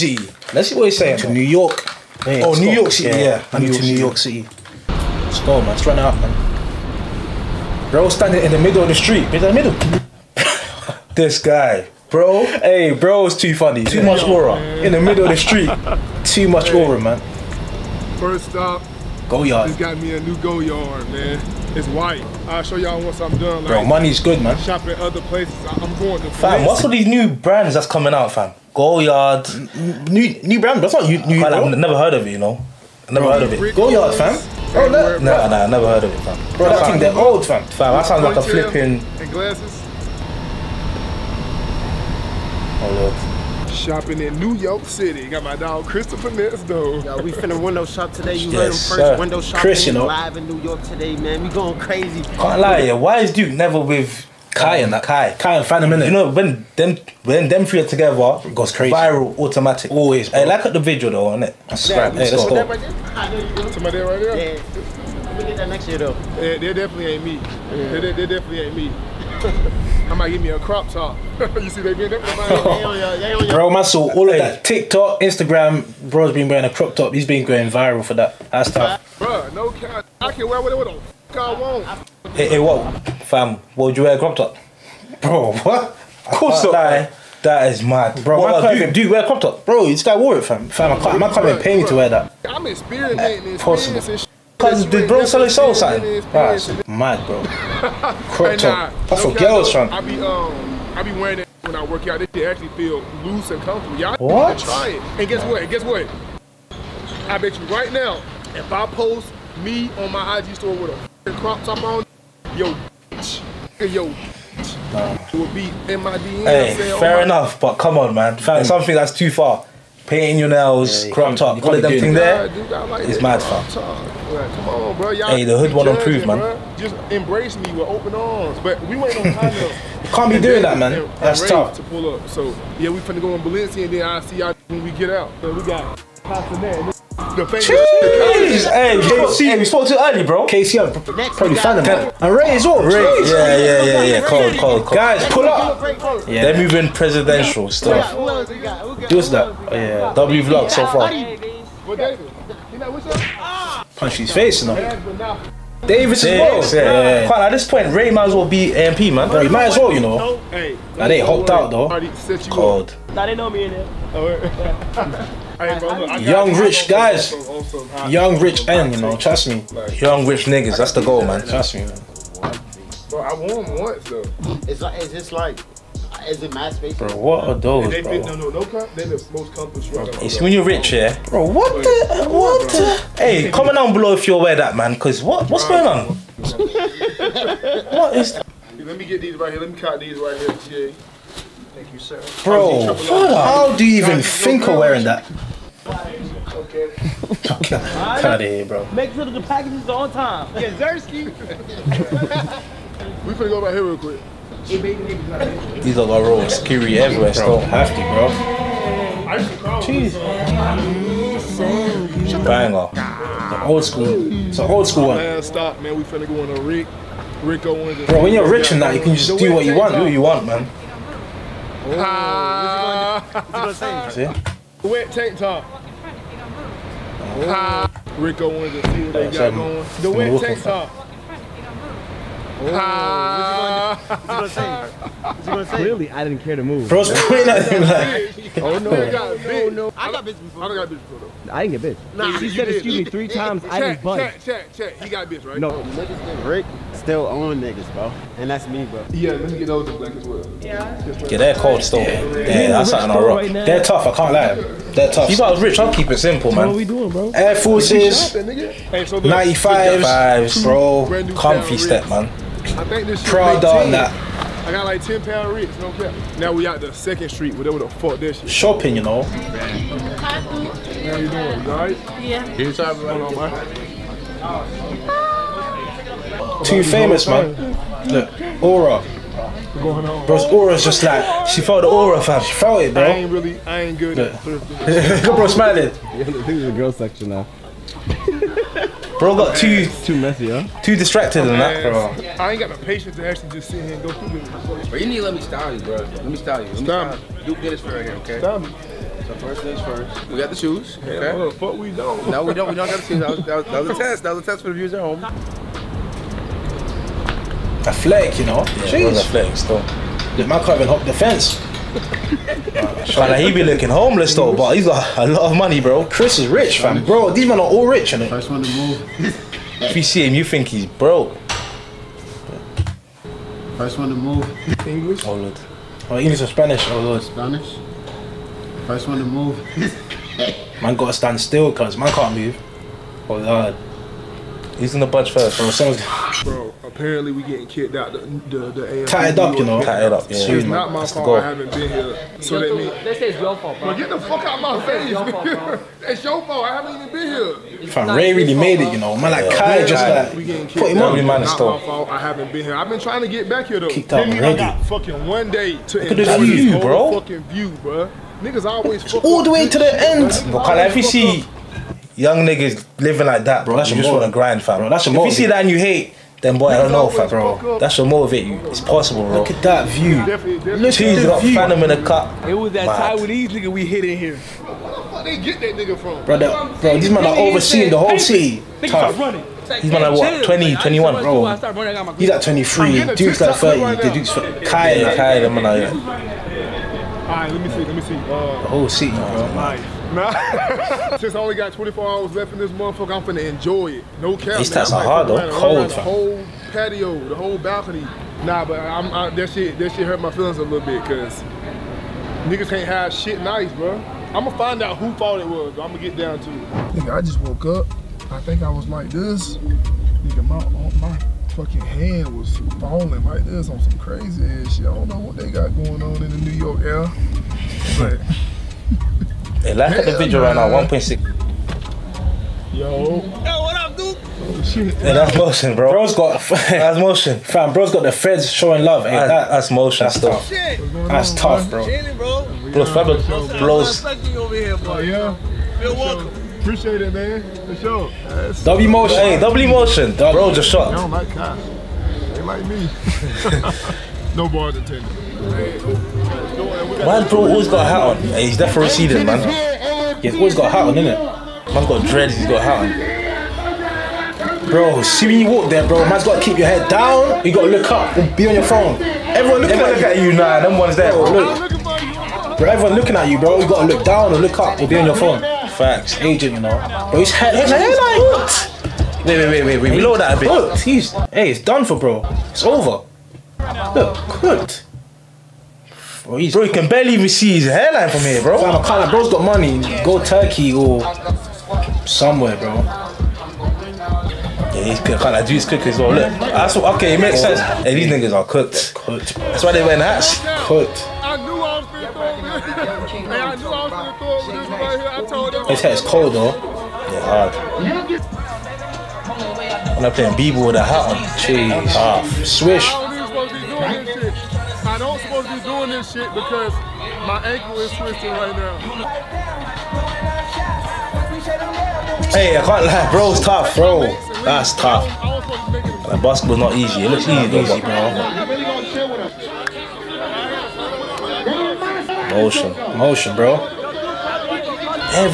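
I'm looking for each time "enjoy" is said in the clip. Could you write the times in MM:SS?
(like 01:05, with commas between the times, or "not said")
05:56, 06:33.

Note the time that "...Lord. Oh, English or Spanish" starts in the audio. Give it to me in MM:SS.
05:25.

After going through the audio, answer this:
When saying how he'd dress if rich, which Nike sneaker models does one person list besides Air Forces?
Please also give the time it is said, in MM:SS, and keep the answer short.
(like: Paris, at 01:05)
95s, at 04:18.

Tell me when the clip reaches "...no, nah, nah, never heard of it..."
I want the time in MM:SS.
00:34.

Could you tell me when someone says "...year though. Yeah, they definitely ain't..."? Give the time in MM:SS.
01:05.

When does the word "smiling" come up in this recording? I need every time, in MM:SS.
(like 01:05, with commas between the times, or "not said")
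04:45.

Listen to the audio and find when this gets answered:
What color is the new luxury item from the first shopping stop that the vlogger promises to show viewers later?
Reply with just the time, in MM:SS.
00:21.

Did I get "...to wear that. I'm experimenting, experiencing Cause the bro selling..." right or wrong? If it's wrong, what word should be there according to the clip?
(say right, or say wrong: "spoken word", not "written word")
right.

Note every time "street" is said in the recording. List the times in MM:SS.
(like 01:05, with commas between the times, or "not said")
00:08, 00:15, 04:27.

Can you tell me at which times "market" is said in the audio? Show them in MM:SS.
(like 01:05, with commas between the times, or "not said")
not said.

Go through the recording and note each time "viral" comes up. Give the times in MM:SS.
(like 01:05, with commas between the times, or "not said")
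00:58, 01:17.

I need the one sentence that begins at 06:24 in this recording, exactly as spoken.
The Duke's Kai, Kai, the man out Alright, let me see, let me see.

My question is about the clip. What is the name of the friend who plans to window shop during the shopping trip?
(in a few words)
Christopher.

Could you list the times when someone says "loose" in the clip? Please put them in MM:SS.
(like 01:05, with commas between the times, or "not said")
01:43.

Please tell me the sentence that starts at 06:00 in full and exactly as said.
Because if you see young niggas living like that, bro, that's you just want to grind, fam.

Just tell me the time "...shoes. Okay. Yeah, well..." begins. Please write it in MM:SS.
05:00.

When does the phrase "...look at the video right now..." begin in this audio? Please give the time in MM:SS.
06:59.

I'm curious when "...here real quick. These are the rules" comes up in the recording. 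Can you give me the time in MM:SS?
03:23.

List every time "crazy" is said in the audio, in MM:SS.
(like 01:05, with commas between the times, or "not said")
00:51, 00:58, 06:53.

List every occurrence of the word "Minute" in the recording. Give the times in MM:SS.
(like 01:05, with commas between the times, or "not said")
00:55.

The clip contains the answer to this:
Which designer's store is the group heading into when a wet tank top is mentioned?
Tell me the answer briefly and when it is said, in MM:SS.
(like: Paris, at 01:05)
Rick Owens, at 03:37.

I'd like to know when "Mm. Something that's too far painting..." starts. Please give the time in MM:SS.
01:58.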